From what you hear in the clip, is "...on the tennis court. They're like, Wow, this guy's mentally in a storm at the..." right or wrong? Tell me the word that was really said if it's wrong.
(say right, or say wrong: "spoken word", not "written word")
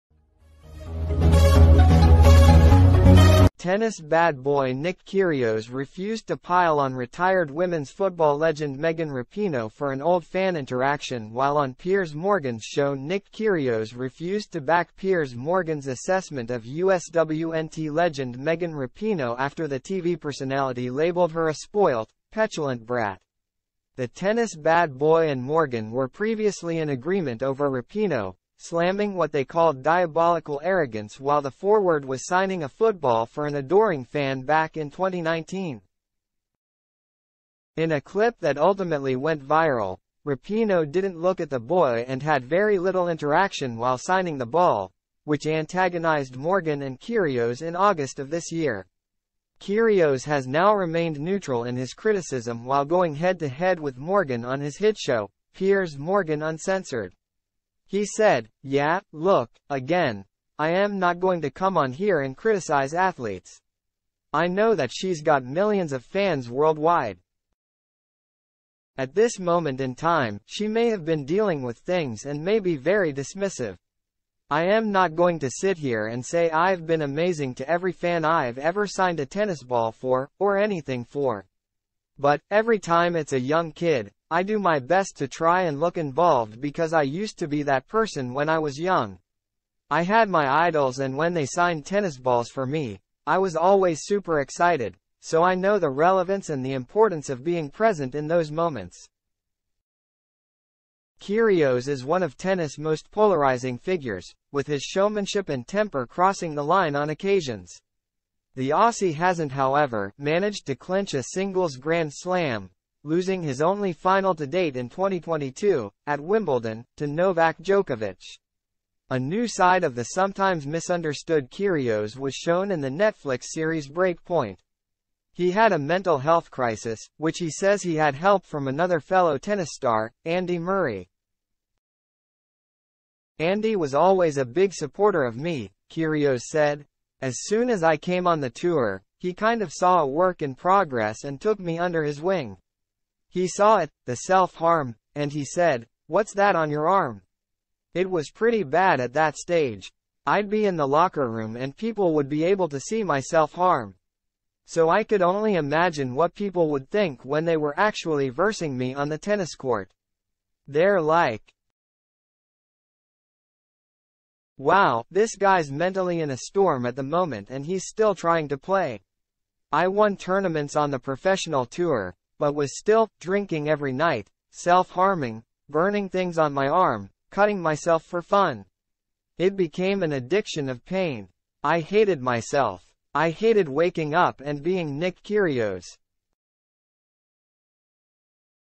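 right.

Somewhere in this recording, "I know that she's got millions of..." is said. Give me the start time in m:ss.
1:04.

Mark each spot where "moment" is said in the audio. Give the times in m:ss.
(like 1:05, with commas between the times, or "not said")
1:09, 1:38, 2:47.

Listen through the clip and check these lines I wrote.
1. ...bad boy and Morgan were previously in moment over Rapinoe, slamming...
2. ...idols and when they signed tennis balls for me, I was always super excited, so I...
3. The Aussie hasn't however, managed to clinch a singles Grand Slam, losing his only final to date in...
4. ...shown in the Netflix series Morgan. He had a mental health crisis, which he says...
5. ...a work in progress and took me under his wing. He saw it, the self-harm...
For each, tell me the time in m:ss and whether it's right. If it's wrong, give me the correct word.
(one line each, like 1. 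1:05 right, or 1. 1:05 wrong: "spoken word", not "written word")
1. 0:24 wrong: "agreement", not "moment"
2. 1:30 right
3. 1:48 right
4. 2:02 wrong: "Breakpoint", not "Morgan"
5. 2:20 right.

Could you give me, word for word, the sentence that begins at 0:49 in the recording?
Kyrgios has now remained neutral in his criticism while going head-to-head -head with Morgan on his hit show, Piers Morgan Uncensored.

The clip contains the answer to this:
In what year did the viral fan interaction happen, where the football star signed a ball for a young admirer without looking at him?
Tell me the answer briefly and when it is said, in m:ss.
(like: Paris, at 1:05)
2019, at 0:34.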